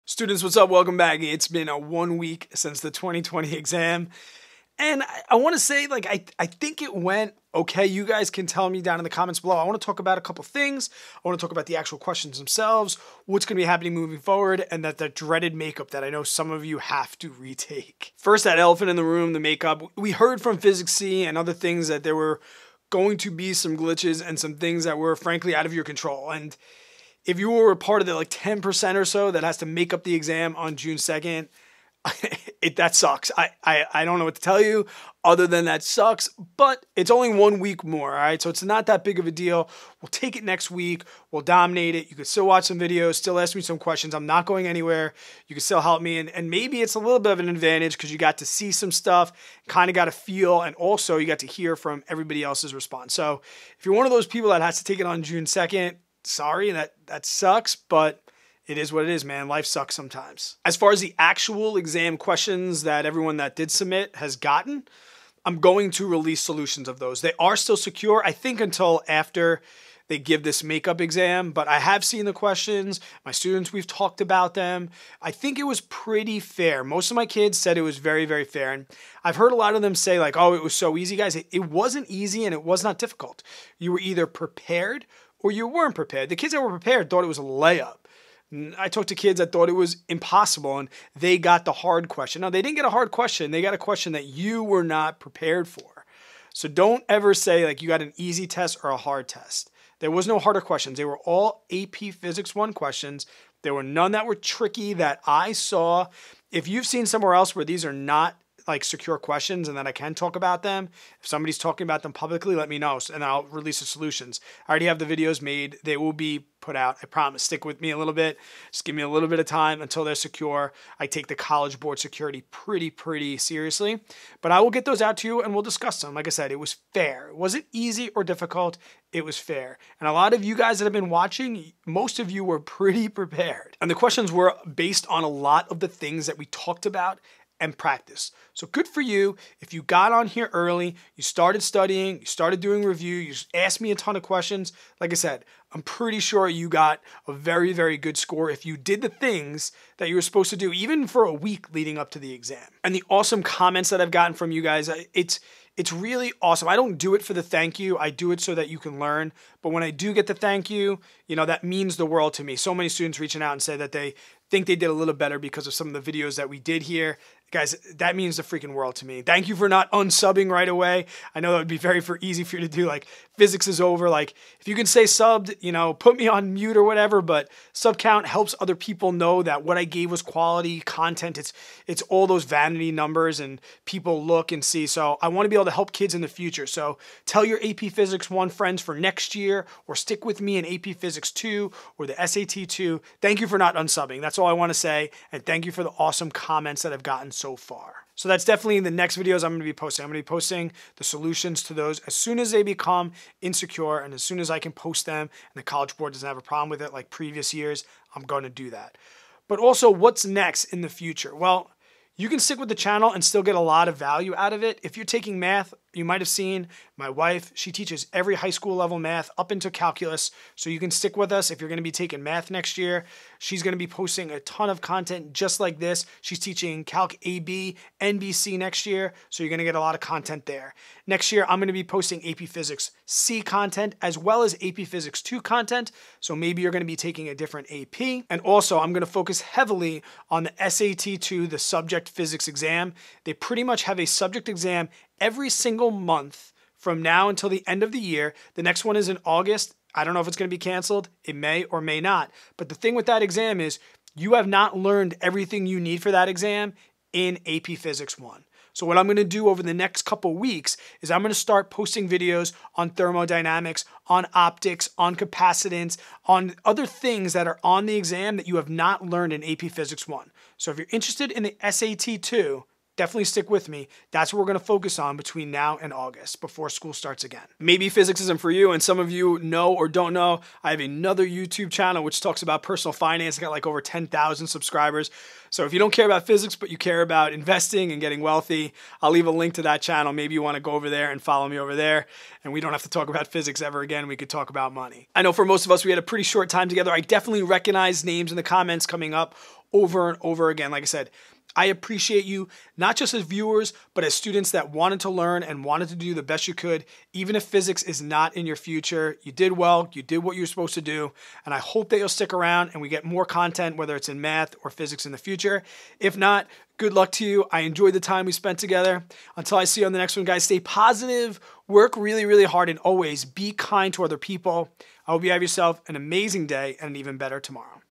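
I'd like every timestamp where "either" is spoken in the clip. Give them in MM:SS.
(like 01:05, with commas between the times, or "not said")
01:24.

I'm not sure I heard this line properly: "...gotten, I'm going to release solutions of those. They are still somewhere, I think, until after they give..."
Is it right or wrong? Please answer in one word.
wrong.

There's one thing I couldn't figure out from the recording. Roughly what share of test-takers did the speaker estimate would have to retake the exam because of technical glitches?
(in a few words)
10%.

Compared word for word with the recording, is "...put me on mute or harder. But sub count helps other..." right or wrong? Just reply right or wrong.
wrong.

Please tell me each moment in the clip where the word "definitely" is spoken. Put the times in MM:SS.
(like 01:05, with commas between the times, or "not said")
03:18, 04:33, 04:57.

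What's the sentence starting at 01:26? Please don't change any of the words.
The kids that were prepared thought it was a layup.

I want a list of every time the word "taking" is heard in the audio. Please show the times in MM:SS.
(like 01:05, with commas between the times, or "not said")
03:35, 03:41, 03:56.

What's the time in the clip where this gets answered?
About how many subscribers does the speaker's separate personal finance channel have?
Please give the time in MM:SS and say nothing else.
04:43.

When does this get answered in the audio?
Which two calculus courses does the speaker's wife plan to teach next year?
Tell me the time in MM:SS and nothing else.
03:46.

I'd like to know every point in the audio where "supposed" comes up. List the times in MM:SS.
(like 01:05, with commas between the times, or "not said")
02:30, 05:10.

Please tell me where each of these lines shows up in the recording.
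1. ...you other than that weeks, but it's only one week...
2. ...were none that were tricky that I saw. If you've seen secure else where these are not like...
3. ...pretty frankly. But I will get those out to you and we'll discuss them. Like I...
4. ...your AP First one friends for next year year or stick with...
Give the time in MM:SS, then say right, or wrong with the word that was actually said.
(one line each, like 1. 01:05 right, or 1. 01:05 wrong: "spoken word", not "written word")
1. 00:34 wrong: "sucks", not "weeks"
2. 01:43 wrong: "somewhere", not "secure"
3. 02:02 wrong: "seriously", not "frankly"
4. 03:07 wrong: "Physics", not "First".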